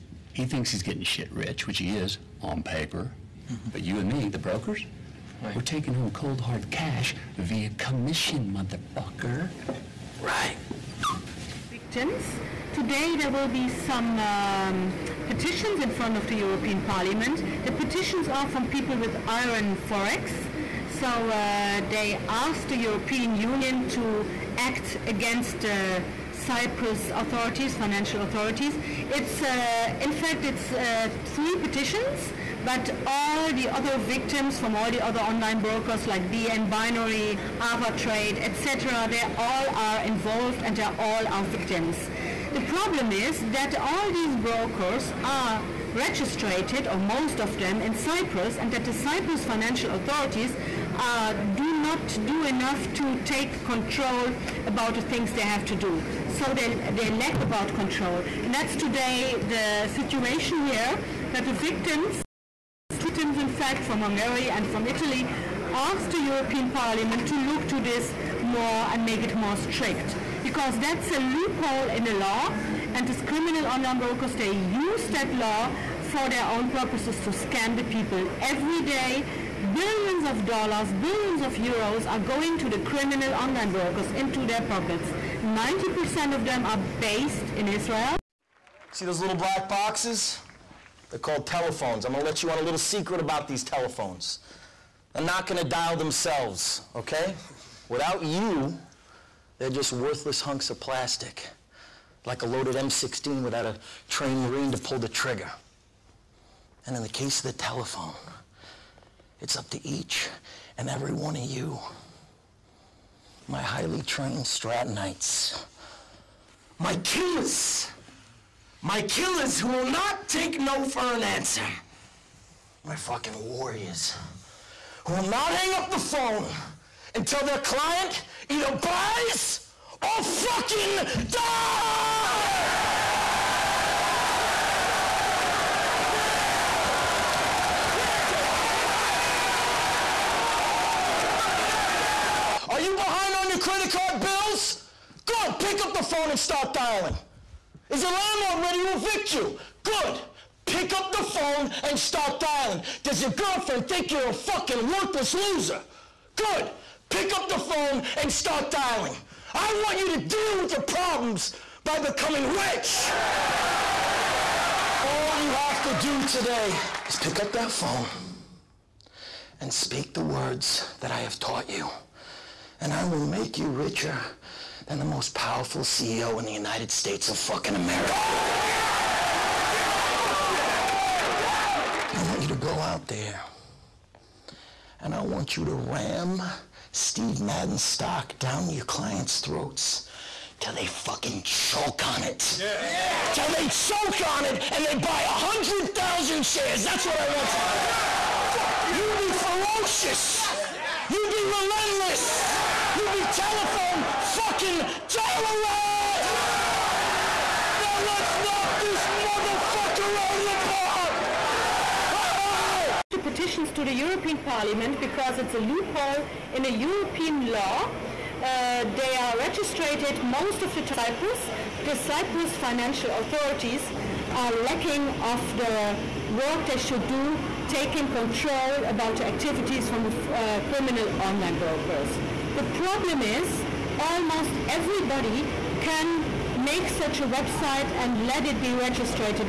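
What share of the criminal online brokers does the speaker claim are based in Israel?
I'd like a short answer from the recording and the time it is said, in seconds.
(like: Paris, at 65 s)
90%, at 85 s.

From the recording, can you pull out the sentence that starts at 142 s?
Are you behind on your credit card bills?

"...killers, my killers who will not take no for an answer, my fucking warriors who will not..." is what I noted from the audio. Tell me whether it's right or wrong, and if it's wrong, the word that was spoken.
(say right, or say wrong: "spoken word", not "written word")
right.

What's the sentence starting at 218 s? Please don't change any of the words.
Uh, they are registered most of the Cyprus.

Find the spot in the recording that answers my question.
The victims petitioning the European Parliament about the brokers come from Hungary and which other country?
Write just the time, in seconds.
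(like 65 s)
64 s.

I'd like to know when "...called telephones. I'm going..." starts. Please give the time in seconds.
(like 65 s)
91 s.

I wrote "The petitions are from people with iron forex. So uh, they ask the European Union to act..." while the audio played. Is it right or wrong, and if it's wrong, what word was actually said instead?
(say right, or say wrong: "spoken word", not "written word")
right.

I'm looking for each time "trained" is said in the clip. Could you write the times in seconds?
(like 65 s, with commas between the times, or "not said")
104 s, 114 s.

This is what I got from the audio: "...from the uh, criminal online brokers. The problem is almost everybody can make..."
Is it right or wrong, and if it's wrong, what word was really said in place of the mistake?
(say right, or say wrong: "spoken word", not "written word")
right.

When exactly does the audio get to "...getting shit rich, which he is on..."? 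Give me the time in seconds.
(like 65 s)
0 s.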